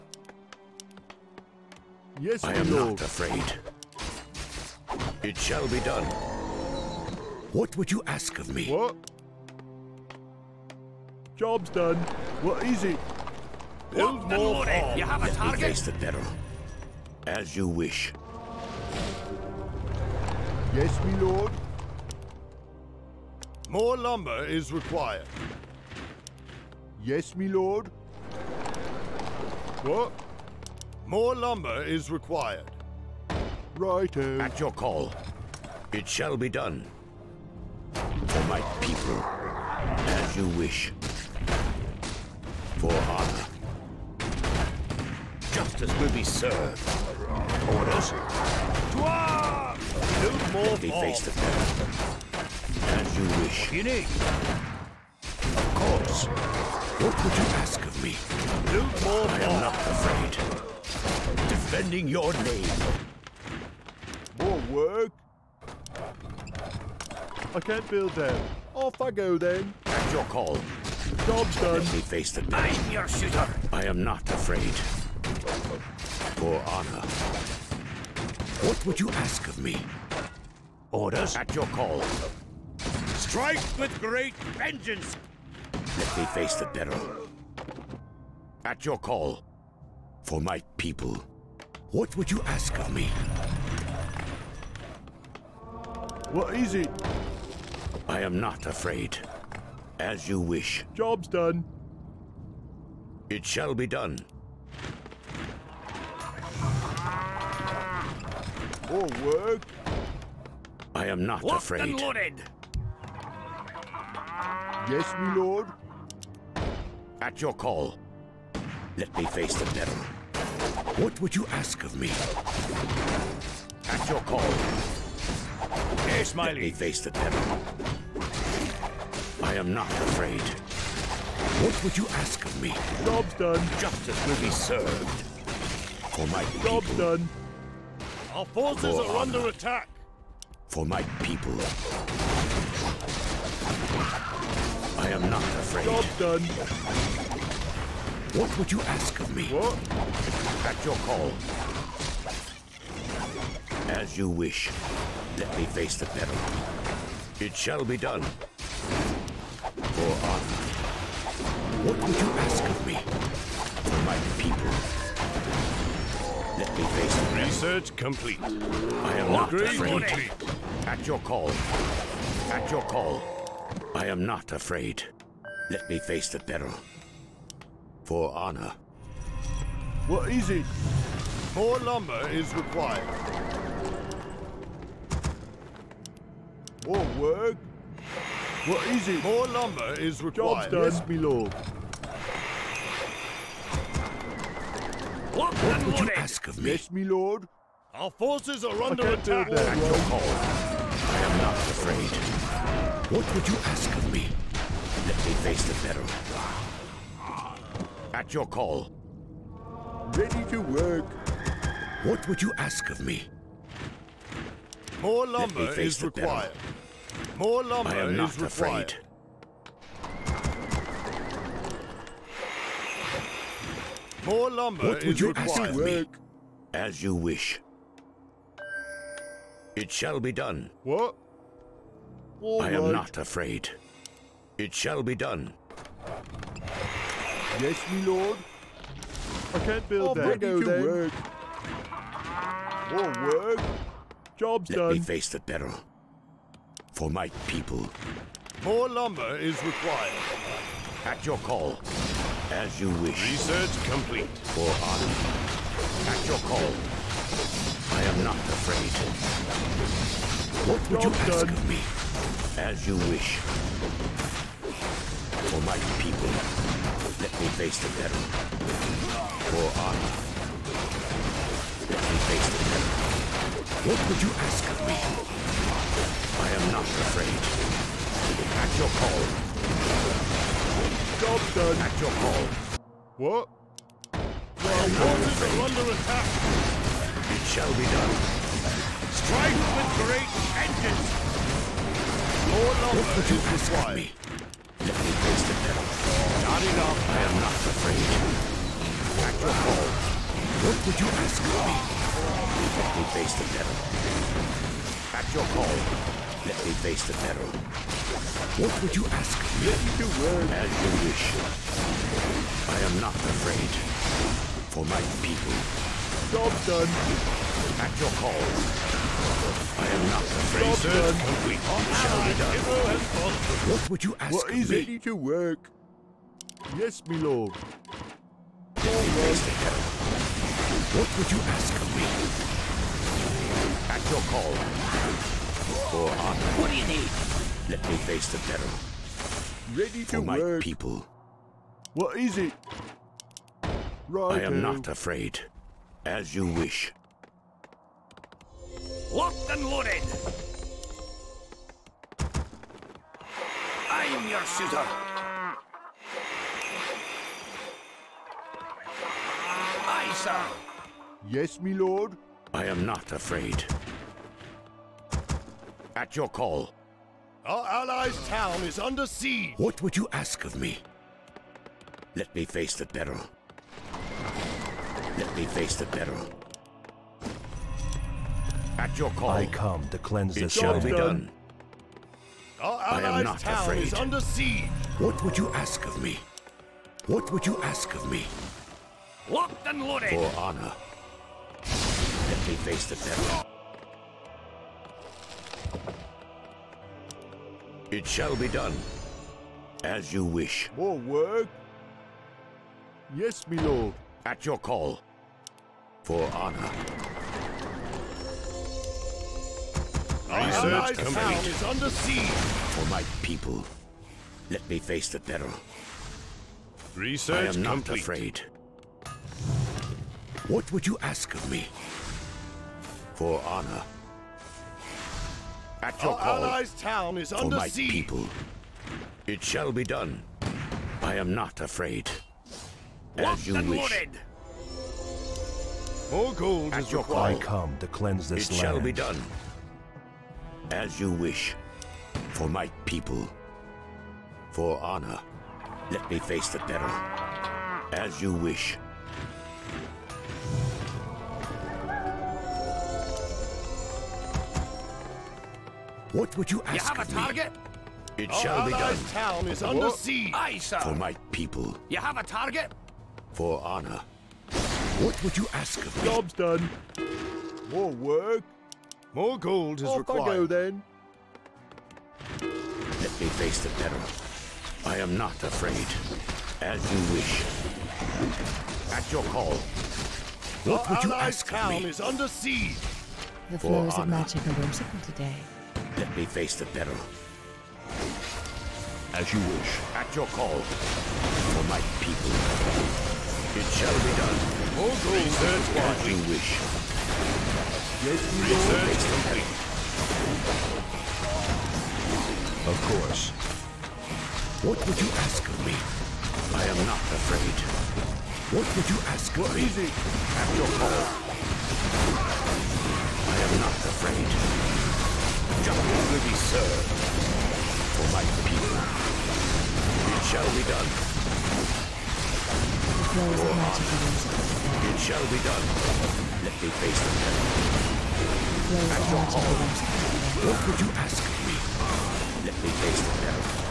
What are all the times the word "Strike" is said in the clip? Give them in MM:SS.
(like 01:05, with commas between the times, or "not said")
01:23, 04:49.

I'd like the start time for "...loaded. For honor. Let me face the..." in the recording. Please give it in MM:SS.
06:29.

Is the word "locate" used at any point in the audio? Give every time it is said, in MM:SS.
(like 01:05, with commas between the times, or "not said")
not said.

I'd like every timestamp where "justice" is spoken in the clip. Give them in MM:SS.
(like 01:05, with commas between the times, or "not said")
00:45, 02:13, 08:35.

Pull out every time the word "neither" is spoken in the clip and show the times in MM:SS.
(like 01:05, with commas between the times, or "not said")
not said.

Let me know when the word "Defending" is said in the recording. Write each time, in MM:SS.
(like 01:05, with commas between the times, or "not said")
01:01.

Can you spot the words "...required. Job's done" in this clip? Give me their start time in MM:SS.
03:10.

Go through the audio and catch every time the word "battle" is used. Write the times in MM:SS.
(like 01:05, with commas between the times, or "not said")
03:25.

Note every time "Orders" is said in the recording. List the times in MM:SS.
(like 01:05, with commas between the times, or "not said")
00:47, 01:20.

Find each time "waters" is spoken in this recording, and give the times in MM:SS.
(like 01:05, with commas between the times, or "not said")
04:44.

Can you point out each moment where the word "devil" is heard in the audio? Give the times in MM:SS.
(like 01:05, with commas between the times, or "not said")
01:59, 02:07, 04:55, 05:03, 08:47.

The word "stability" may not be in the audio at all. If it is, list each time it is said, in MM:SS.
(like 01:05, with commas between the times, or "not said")
not said.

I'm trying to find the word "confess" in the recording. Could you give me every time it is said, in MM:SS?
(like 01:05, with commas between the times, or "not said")
not said.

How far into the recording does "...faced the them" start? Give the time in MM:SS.
00:50.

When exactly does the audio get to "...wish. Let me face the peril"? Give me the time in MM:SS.
02:34.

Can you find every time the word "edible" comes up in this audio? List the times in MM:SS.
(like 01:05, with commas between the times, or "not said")
not said.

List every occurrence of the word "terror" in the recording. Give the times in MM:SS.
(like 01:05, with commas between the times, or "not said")
05:38.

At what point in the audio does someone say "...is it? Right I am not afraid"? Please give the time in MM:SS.
05:42.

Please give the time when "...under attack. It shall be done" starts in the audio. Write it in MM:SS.
04:45.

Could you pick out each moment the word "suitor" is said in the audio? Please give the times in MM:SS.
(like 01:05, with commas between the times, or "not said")
05:54.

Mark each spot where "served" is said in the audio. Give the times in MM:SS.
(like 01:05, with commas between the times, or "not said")
00:46, 02:14, 08:36.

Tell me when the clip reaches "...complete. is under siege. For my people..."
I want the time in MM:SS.
06:50.